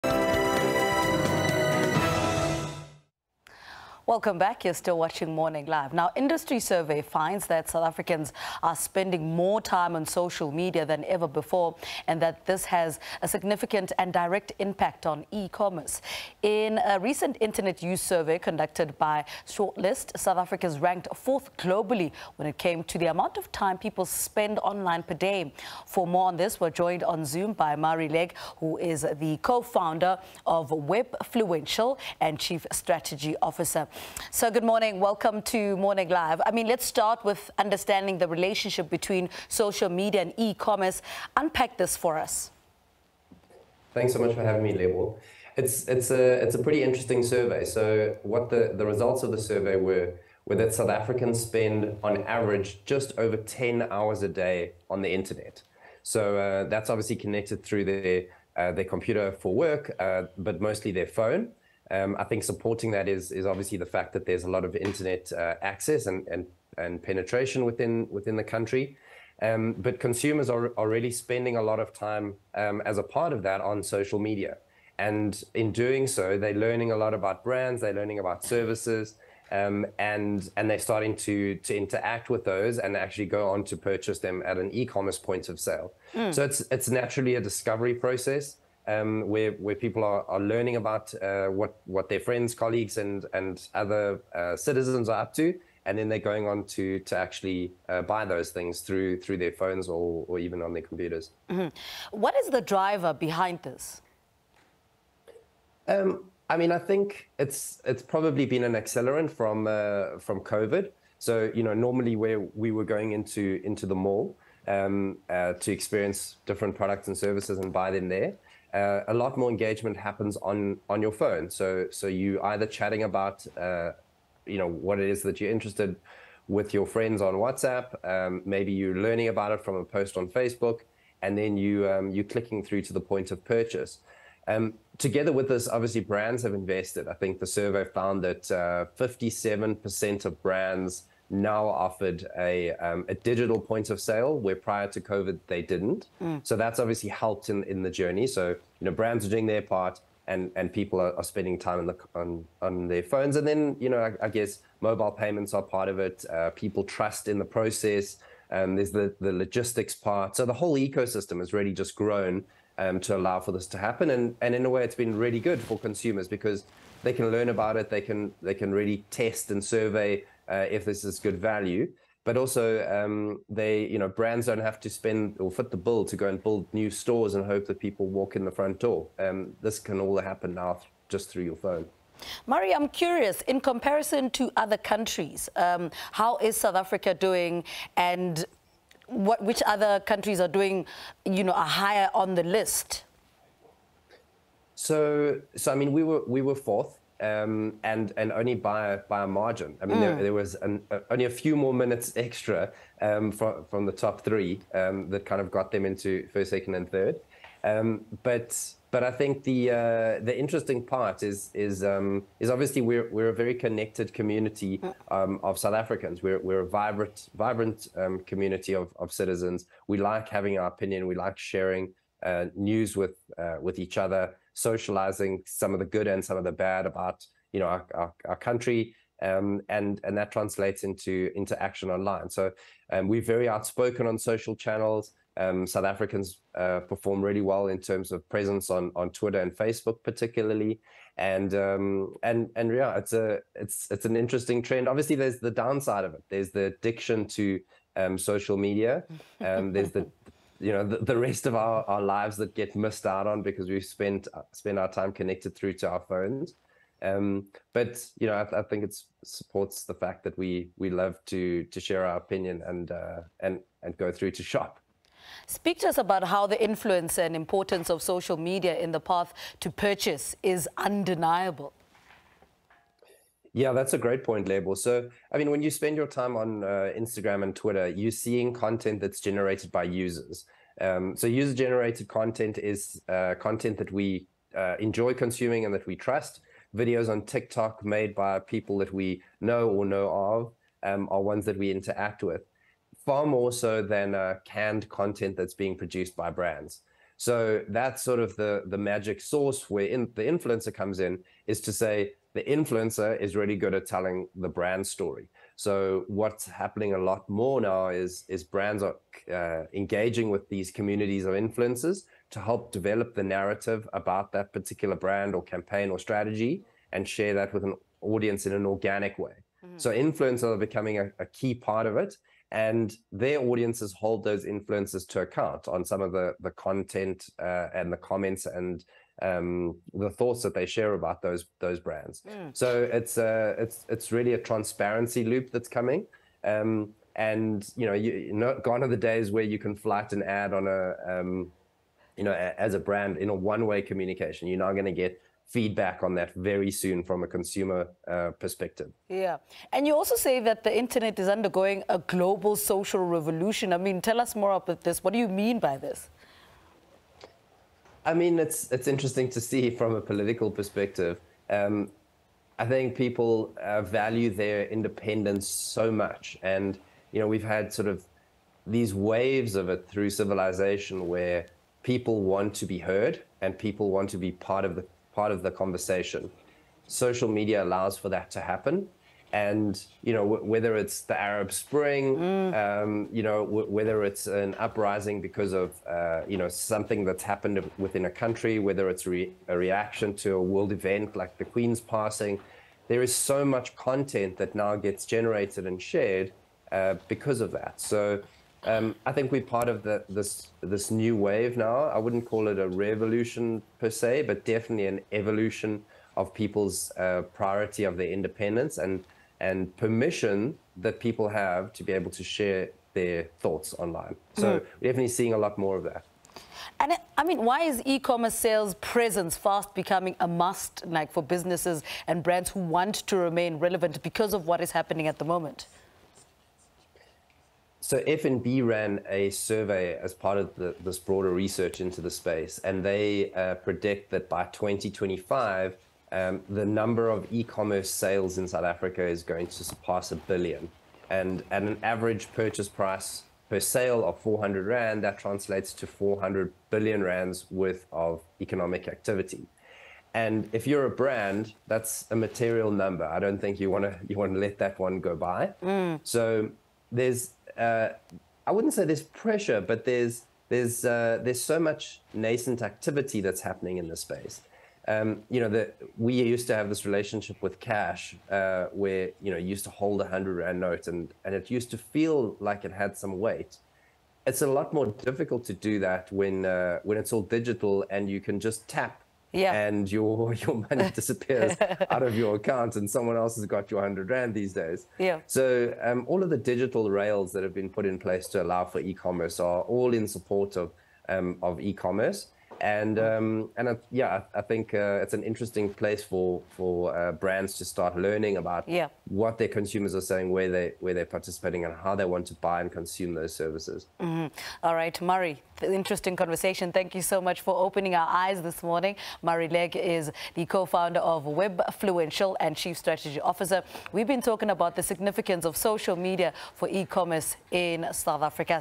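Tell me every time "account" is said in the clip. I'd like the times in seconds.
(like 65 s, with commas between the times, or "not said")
325 s, 482 s.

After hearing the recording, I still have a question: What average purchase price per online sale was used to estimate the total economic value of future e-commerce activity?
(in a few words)
R400.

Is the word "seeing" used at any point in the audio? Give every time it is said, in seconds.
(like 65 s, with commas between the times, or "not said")
278 s, 415 s.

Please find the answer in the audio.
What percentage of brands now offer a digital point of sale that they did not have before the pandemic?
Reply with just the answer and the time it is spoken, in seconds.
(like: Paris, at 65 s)
57%, at 138 s.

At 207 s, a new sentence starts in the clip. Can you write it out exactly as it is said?
Um, but but I think the uh, the interesting part is is um, is obviously we're we're a very connected community mm.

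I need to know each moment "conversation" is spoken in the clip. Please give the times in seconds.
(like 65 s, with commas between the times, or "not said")
375 s, 506 s.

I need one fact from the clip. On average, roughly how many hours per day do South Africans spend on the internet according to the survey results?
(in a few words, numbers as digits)
Just over 10 hours.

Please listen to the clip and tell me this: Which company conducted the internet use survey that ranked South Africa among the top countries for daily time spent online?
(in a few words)
Sortlist.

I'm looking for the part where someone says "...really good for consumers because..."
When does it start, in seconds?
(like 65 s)
165 s.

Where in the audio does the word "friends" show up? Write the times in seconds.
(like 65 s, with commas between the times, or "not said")
92 s, 126 s.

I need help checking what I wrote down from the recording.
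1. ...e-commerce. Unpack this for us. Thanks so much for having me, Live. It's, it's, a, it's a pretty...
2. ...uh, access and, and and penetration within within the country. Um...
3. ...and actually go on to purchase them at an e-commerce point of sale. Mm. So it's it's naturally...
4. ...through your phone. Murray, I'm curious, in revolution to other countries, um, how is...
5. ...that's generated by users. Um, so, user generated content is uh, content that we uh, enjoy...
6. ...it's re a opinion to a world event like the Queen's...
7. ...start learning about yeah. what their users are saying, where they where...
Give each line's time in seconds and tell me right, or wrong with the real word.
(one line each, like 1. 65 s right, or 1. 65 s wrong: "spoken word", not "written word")
1. 40 s wrong: "Label", not "Live"
2. 65 s right
3. 82 s right
4. 181 s wrong: "comparison", not "revolution"
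5. 279 s right
6. 388 s wrong: "reaction", not "opinion"
7. 497 s wrong: "consumers", not "users".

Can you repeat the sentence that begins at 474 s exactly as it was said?
It's a lot more difficult to do that when, uh, when it's all digital and you can just tap yeah.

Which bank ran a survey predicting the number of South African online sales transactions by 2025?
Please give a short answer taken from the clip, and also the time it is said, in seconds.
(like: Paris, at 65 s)
FNB, at 428 s.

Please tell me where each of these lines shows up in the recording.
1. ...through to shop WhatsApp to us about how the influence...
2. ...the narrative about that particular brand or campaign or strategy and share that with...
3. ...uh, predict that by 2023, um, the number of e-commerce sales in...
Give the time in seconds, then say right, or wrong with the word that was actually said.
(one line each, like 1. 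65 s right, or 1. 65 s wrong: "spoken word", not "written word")
1. 264 s wrong: "Speak", not "WhatsApp"
2. 313 s right
3. 433 s wrong: "2025", not "2023".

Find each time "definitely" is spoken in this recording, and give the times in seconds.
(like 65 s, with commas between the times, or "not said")
404 s, 414 s.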